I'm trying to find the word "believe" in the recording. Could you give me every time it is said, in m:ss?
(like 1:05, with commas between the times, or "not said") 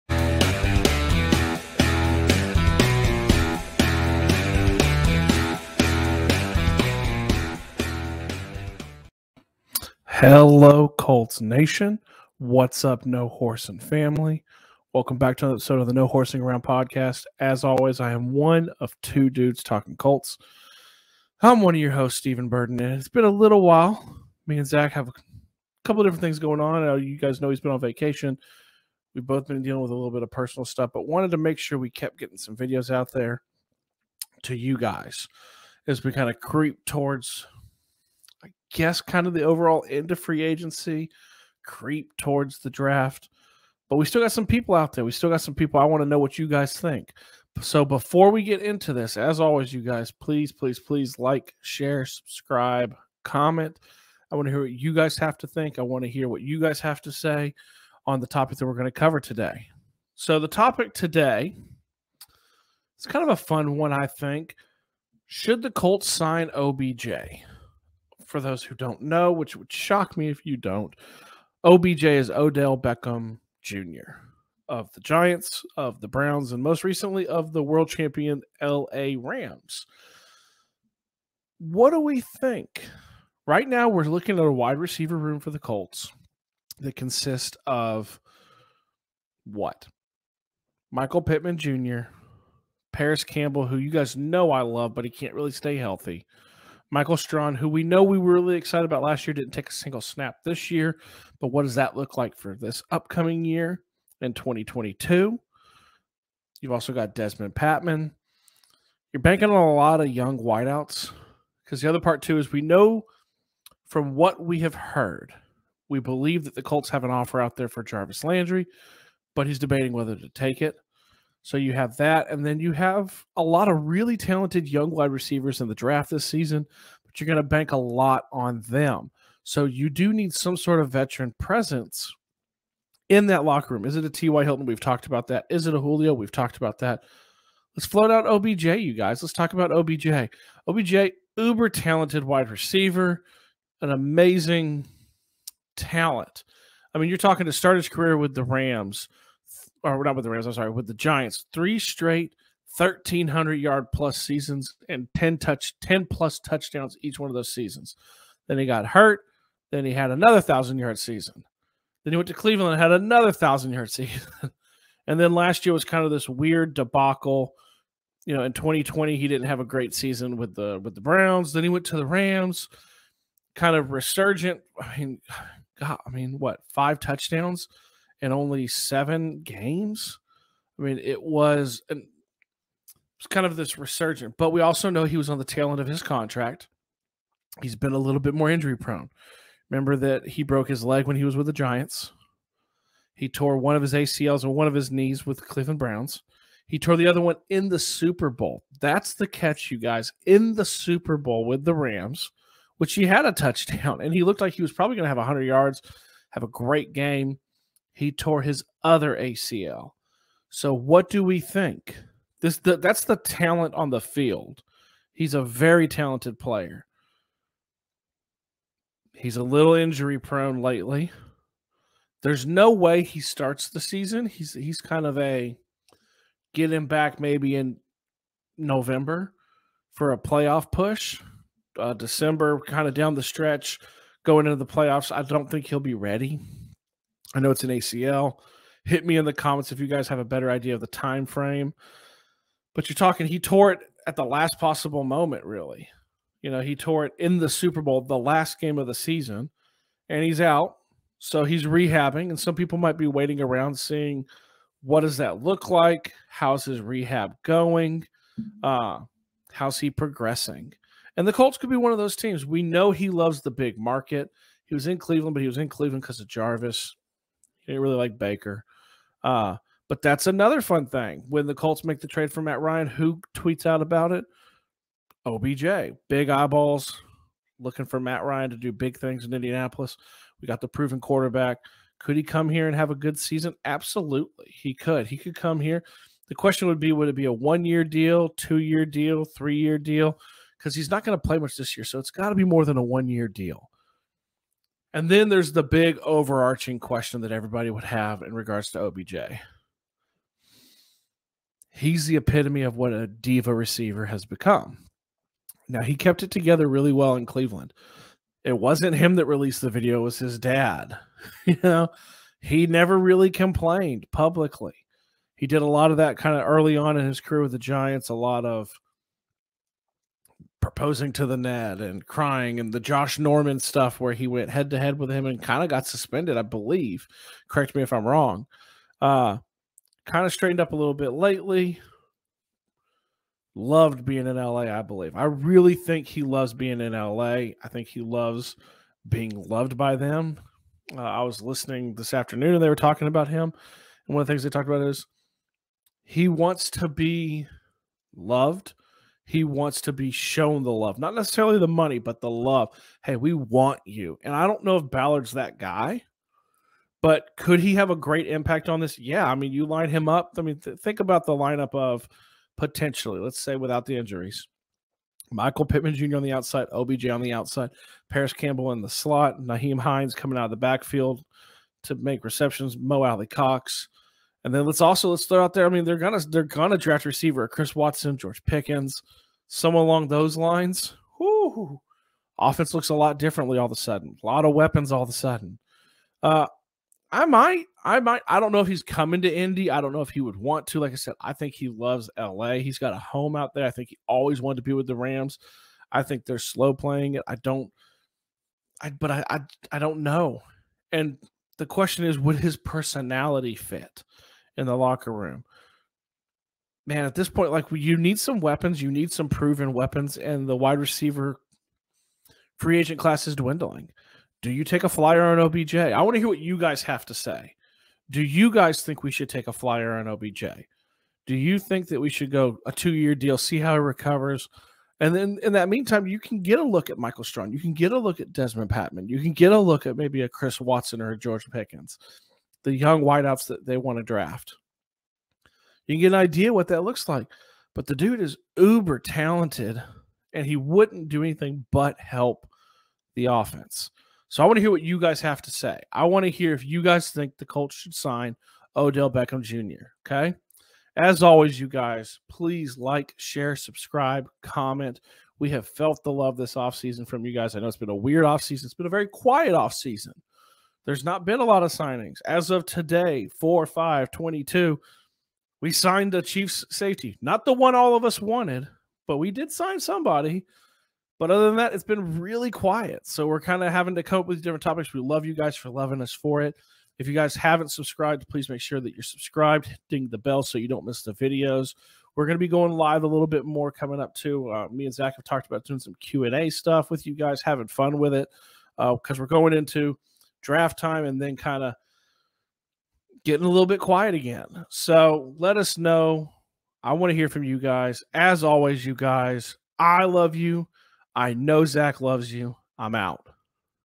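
1:55, 5:26, 5:34.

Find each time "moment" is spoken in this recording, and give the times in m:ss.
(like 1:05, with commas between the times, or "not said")
4:05.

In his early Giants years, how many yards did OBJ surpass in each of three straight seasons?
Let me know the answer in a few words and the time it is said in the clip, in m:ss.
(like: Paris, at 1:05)
1300, at 2:32.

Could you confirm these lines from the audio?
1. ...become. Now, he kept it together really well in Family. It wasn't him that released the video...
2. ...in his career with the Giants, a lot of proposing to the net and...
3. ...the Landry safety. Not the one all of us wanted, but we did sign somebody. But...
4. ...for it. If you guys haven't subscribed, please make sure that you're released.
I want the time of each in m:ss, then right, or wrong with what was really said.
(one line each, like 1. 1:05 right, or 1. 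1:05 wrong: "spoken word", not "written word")
1. 5:04 wrong: "Cleveland", not "Family"
2. 5:16 right
3. 7:46 wrong: "Chiefs", not "Landry"
4. 7:56 wrong: "subscribed", not "released".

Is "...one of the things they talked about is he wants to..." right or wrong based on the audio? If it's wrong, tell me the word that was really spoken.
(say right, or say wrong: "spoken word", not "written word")
right.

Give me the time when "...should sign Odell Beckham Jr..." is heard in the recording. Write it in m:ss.
7:27.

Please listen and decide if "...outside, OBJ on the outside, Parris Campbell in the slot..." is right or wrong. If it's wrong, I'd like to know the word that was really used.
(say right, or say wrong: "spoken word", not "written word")
right.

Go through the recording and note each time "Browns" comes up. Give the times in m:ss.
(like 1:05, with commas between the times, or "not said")
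1:16, 2:51, 3:15.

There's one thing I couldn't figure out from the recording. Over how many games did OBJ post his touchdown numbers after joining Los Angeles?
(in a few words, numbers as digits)
7.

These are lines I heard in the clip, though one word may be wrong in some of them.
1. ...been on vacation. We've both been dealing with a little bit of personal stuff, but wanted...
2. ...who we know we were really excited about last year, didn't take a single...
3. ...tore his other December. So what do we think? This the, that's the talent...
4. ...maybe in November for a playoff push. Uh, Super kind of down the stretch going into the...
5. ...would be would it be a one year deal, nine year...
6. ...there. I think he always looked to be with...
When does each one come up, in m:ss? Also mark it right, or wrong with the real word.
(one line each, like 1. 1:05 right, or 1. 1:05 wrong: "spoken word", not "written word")
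1. 0:27 right
2. 1:37 right
3. 3:28 wrong: "ACL", not "December"
4. 3:47 wrong: "December", not "Super"
5. 4:46 wrong: "two", not "nine"
6. 6:33 wrong: "wanted", not "looked".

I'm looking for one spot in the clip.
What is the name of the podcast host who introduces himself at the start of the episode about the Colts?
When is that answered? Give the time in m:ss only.
0:22.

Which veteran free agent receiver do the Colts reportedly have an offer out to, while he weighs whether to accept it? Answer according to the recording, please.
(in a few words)
Jarvis Landry.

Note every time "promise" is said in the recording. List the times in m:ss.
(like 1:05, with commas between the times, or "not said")
not said.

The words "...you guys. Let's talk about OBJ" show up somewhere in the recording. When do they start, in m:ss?
2:18.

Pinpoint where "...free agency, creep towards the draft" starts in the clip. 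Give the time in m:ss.
0:40.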